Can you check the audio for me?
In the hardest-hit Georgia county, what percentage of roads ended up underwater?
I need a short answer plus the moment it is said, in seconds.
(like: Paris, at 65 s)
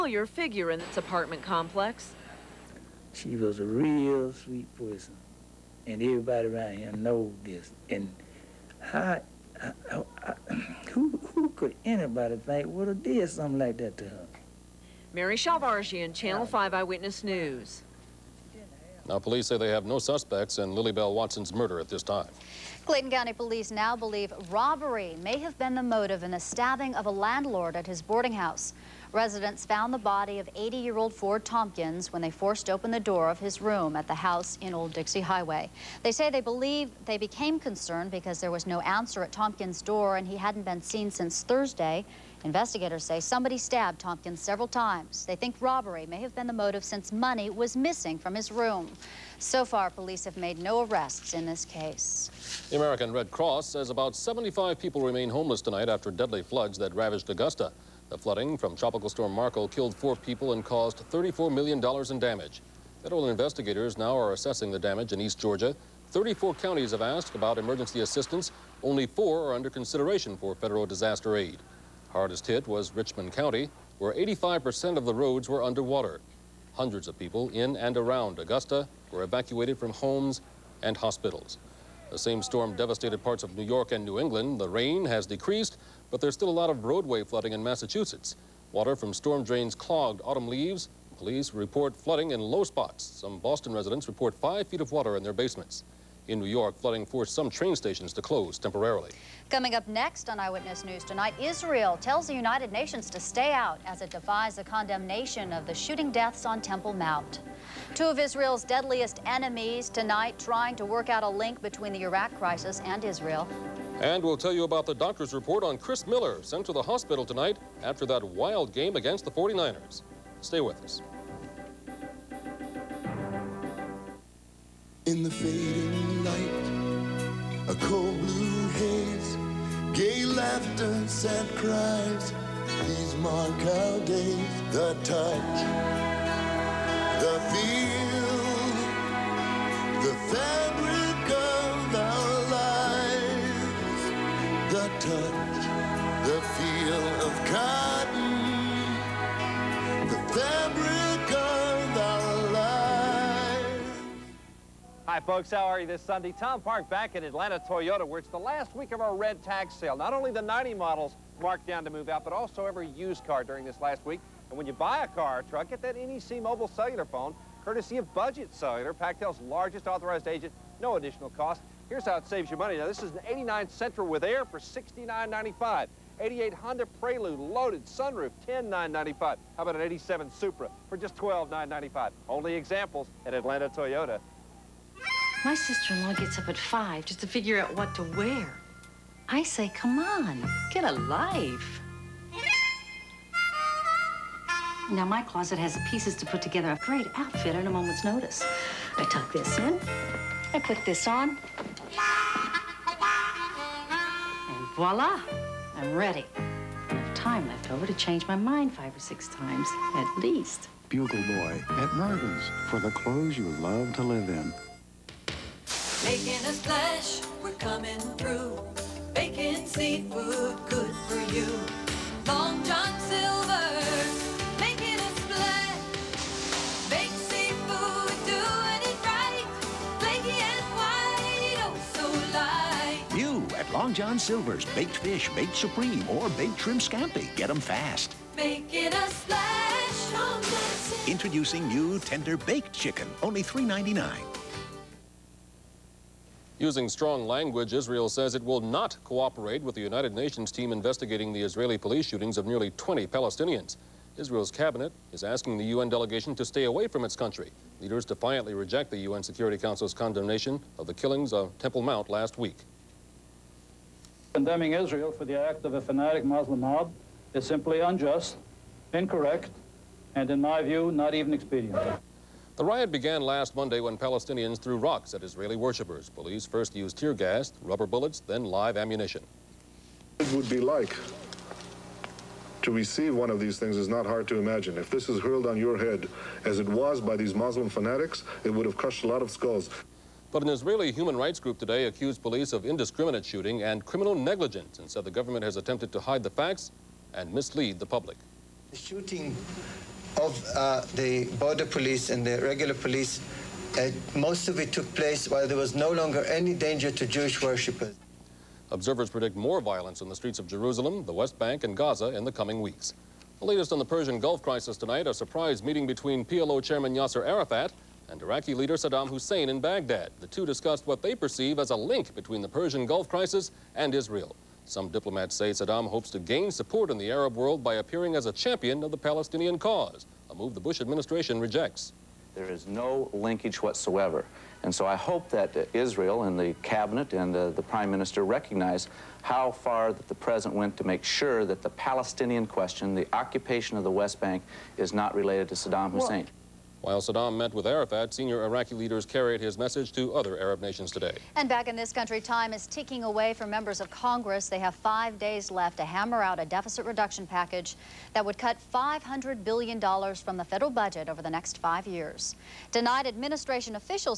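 85%, at 74 s.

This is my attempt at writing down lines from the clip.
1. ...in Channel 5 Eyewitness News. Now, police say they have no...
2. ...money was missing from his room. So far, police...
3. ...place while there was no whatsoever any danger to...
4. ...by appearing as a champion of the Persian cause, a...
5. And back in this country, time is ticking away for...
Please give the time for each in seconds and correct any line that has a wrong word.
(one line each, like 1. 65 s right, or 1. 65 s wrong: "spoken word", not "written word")
1. 15 s right
2. 47 s right
3. 304 s wrong: "longer", not "whatsoever"
4. 327 s wrong: "Palestinian", not "Persian"
5. 351 s right.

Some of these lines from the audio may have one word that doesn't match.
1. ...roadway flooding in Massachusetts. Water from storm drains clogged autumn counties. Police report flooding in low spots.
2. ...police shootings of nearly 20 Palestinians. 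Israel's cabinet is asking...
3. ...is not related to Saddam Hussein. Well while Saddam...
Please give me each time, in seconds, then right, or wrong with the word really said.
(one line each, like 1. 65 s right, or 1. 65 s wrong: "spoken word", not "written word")
1. 86 s wrong: "leaves", not "counties"
2. 251 s right
3. 344 s right.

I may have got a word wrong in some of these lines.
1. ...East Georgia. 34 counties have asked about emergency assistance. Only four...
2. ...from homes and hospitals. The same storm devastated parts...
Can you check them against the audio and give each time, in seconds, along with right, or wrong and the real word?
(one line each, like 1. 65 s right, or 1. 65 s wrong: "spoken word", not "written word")
1. 65 s right
2. 79 s right.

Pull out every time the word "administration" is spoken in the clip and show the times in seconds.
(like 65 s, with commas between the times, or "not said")
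330 s, 363 s.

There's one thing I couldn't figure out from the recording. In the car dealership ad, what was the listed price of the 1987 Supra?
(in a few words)
$12,995.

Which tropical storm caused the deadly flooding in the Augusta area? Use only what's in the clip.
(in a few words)
Marco.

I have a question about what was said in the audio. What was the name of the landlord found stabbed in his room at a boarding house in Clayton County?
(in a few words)
Ford Tompkins.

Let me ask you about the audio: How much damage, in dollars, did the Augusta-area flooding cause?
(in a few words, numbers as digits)
$34 million.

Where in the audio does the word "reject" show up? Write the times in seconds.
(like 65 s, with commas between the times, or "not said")
258 s, 331 s.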